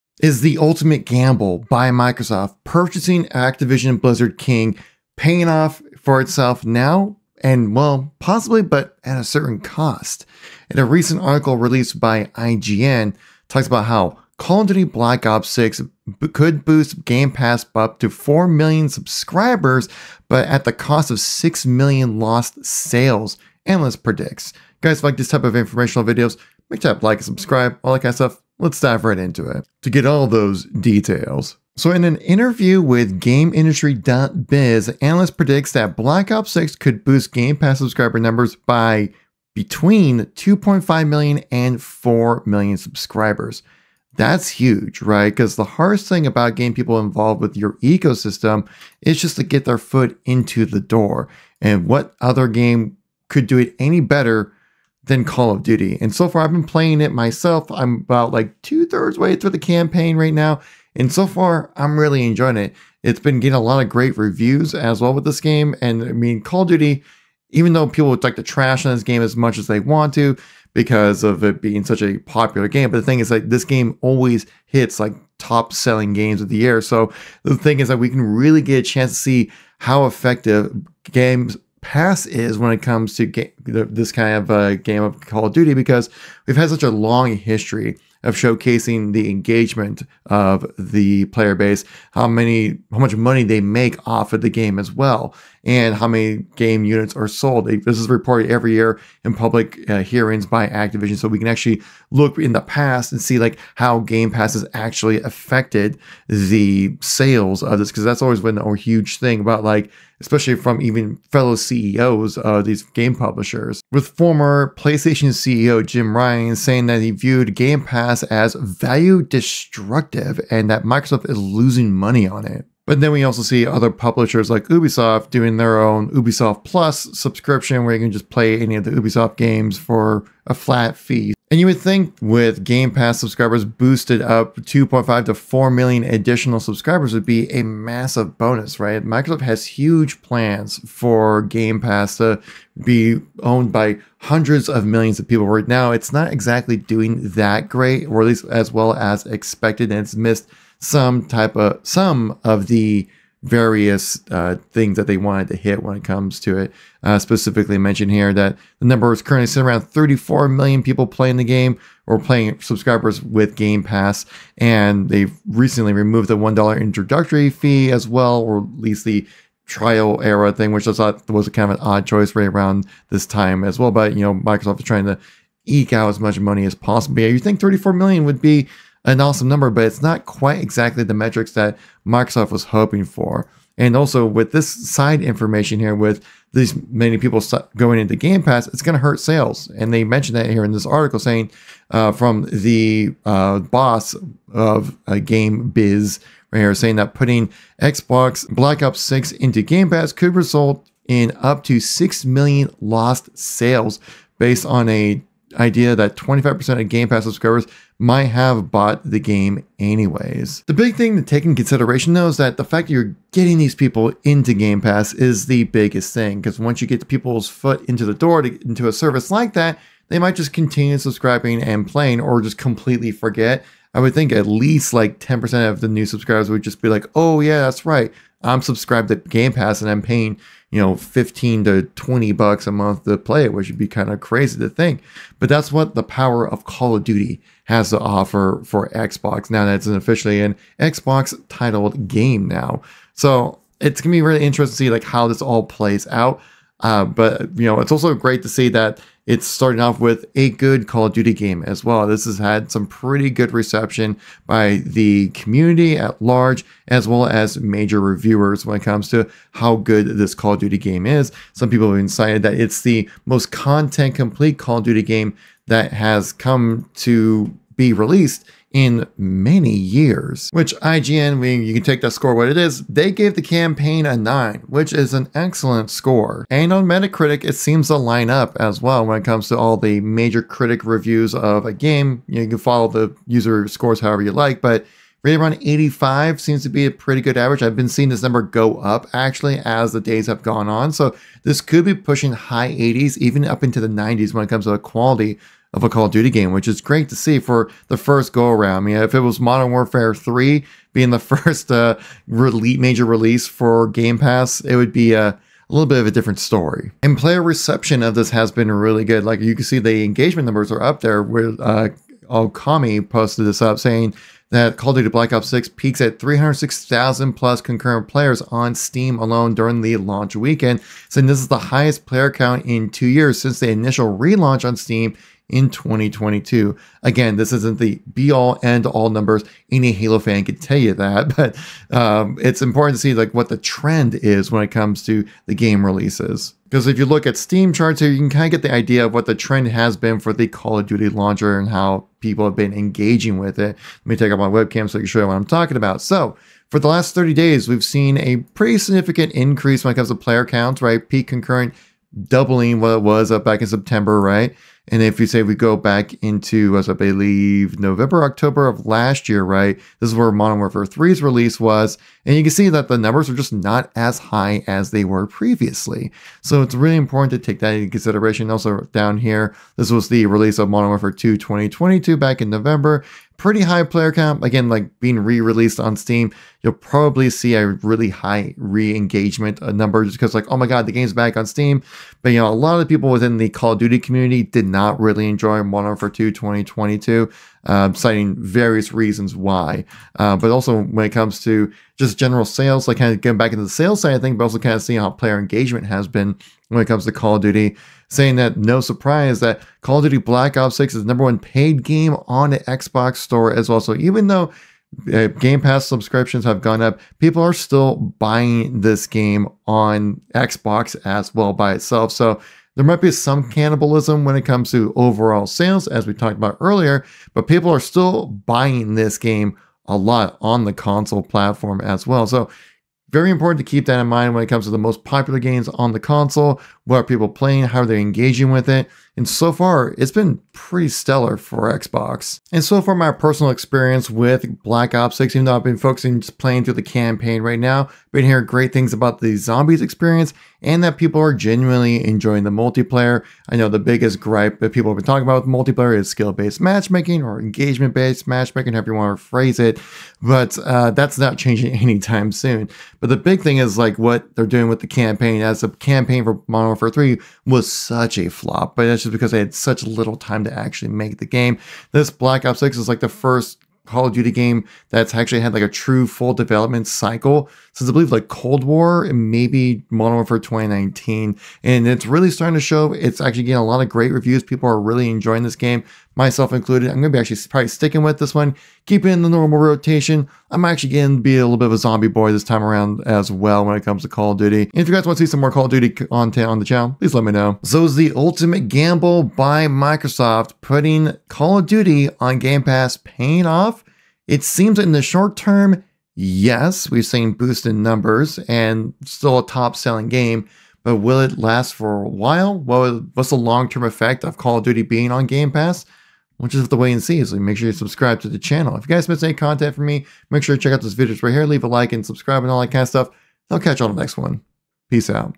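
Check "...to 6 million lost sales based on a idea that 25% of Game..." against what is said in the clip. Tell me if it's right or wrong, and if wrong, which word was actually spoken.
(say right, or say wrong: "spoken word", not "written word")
right.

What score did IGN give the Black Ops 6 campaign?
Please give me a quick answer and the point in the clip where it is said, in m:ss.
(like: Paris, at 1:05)
9, at 4:34.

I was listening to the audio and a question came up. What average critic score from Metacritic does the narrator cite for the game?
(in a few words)
85.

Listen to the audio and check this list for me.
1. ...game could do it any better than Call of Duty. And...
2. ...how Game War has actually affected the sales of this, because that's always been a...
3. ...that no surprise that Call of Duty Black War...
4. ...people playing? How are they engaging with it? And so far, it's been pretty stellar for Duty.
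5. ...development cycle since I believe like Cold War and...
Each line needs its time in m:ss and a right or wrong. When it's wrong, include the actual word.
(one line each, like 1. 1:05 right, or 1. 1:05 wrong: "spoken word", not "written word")
1. 0:52 right
2. 1:43 wrong: "Pass", not "War"
3. 6:38 wrong: "Ops", not "War"
4. 7:07 wrong: "Xbox", not "Duty"
5. 7:46 right.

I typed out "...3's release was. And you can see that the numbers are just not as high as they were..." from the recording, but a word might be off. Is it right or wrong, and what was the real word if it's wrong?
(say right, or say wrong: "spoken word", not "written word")
right.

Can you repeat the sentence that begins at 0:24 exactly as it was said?
You guys like this type of informational videos, make sure to like and subscribe, all that kind of stuff.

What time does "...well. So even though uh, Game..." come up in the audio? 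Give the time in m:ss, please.
6:43.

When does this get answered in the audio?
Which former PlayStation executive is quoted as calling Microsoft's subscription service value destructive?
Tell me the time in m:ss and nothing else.
1:55.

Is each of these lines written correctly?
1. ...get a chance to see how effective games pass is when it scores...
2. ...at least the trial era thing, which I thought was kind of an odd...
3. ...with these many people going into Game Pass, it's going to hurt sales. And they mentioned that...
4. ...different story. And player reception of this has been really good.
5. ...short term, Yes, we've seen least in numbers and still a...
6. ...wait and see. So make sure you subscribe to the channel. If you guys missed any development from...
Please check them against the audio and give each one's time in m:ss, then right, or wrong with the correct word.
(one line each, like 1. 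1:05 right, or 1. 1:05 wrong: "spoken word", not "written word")
1. 1:18 wrong: "comes", not "scores"
2. 2:48 right
3. 3:05 right
4. 5:06 right
5. 8:15 wrong: "boost", not "least"
6. 8:26 wrong: "content", not "development".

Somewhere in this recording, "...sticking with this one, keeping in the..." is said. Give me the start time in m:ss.
7:57.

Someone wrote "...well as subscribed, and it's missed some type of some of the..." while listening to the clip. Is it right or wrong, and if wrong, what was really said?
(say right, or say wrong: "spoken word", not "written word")
wrong: "expected", not "subscribed".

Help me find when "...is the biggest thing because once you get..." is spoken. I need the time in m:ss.
3:35.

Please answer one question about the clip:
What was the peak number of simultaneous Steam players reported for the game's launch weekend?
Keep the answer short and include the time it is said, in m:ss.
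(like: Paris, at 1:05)
306,000, at 5:16.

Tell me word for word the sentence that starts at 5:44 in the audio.
Let me take up my webcam so I can show you what I'm talking about.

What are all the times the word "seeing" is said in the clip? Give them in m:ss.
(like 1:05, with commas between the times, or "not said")
4:47, 6:34.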